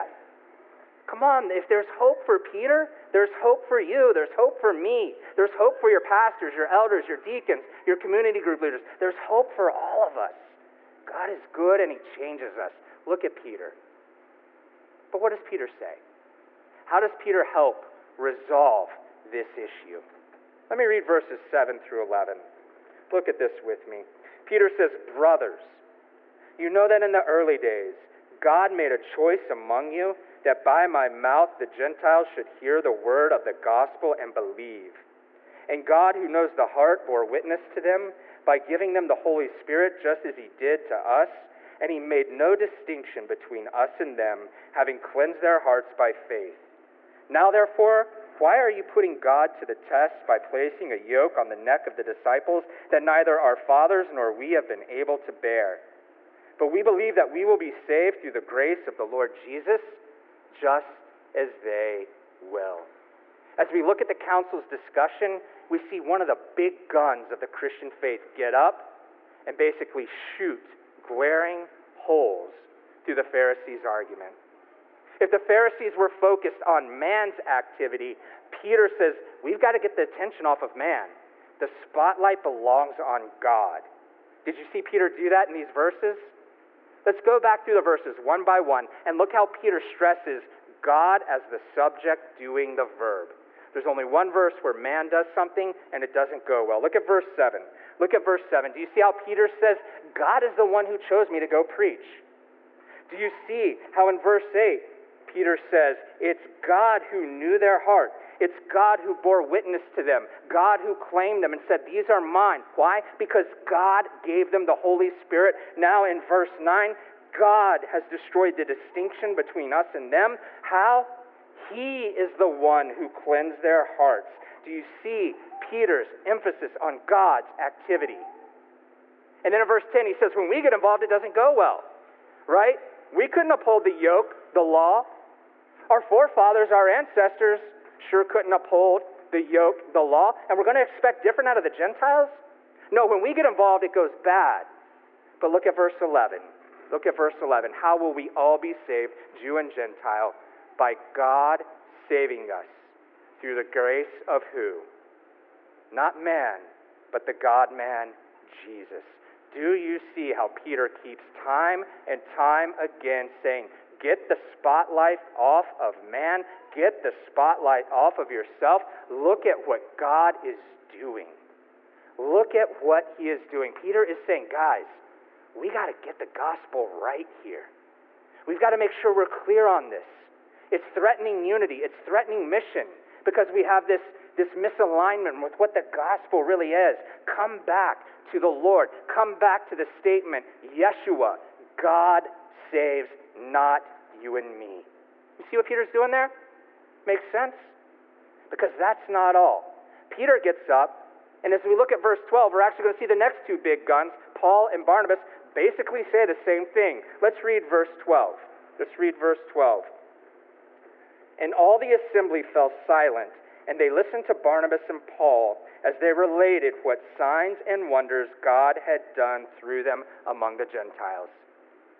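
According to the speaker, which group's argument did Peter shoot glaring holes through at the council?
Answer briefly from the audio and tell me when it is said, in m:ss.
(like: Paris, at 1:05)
The Pharisees, at 1:13.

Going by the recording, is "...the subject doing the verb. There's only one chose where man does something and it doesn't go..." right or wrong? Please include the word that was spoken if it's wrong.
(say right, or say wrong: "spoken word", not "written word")
wrong: "verse", not "chose".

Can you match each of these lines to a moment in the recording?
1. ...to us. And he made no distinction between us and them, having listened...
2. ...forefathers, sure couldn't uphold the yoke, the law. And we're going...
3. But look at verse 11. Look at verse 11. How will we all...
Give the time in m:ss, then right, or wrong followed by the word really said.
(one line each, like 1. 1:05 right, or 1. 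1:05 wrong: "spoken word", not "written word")
1. 0:40 wrong: "cleansed", not "listened"
2. 2:16 wrong: "ancestors", not "forefathers"
3. 2:25 right.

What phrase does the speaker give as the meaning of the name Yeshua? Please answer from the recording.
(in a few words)
God saves.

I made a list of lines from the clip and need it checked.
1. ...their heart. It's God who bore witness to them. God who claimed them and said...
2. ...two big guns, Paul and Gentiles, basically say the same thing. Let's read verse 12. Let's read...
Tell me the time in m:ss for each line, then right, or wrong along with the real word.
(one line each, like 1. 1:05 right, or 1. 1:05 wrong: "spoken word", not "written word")
1. 1:47 right
2. 3:23 wrong: "Barnabas", not "Gentiles".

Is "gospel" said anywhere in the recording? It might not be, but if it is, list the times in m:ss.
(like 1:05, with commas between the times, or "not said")
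0:33, 2:56, 3:05.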